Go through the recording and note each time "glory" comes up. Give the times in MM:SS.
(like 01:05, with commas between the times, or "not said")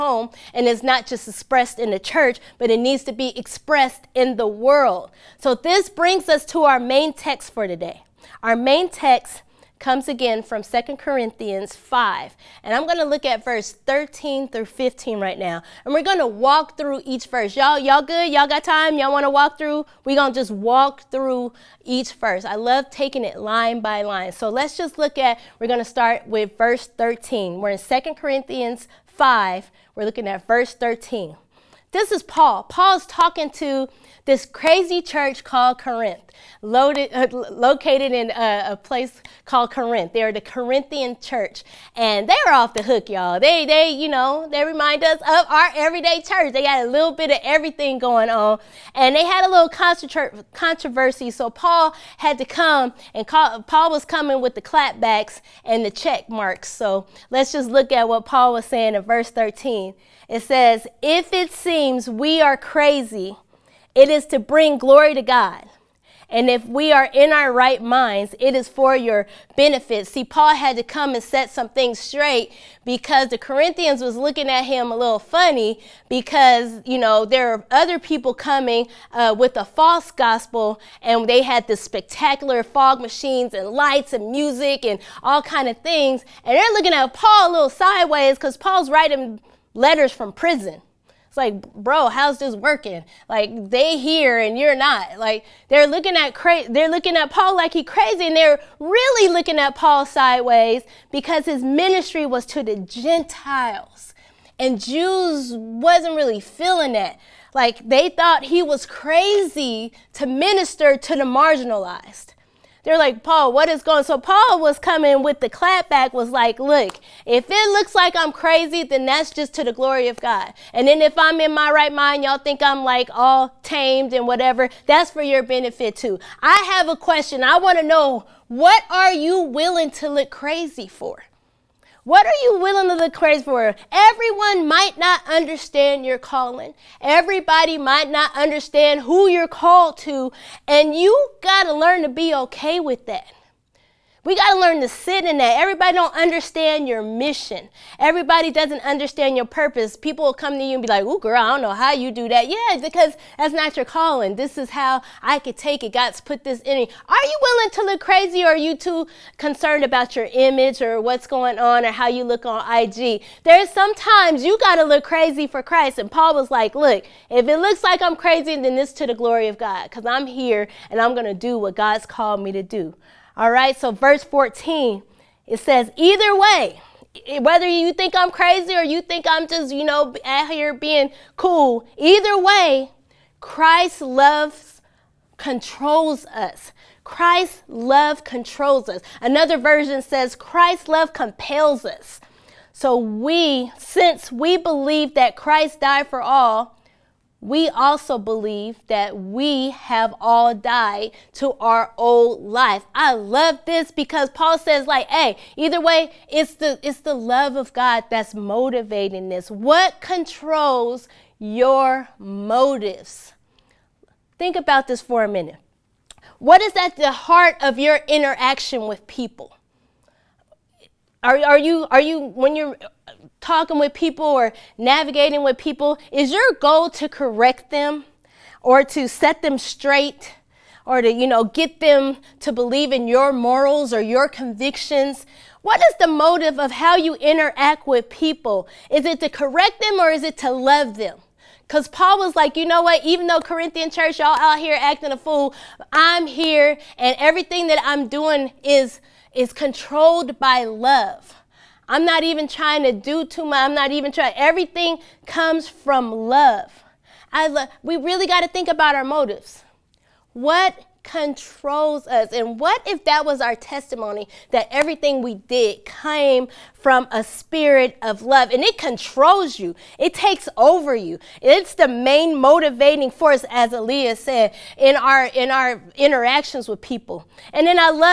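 01:04, 01:59, 02:49.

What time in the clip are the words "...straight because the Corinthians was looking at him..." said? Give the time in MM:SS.
01:11.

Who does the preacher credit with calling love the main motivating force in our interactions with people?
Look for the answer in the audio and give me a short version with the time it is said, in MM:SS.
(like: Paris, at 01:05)
Aaliyah, at 04:33.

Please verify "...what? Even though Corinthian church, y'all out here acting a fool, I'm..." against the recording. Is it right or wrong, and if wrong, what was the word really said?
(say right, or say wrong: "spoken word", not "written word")
right.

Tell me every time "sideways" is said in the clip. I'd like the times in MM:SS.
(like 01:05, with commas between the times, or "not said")
01:27, 01:40.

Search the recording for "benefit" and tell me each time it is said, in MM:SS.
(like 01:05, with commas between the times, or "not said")
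01:09, 02:05.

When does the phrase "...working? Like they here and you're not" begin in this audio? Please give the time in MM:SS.
01:32.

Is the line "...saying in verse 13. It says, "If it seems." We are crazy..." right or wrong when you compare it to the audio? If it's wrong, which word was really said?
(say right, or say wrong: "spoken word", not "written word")
right.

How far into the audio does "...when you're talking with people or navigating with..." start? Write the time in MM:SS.
03:42.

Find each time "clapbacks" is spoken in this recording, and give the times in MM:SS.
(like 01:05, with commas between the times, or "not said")
00:54, 01:55.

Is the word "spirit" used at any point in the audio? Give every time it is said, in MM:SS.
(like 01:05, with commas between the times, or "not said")
04:27.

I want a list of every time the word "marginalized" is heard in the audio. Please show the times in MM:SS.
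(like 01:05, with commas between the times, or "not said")
01:51.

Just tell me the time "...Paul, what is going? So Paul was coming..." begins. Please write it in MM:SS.
01:53.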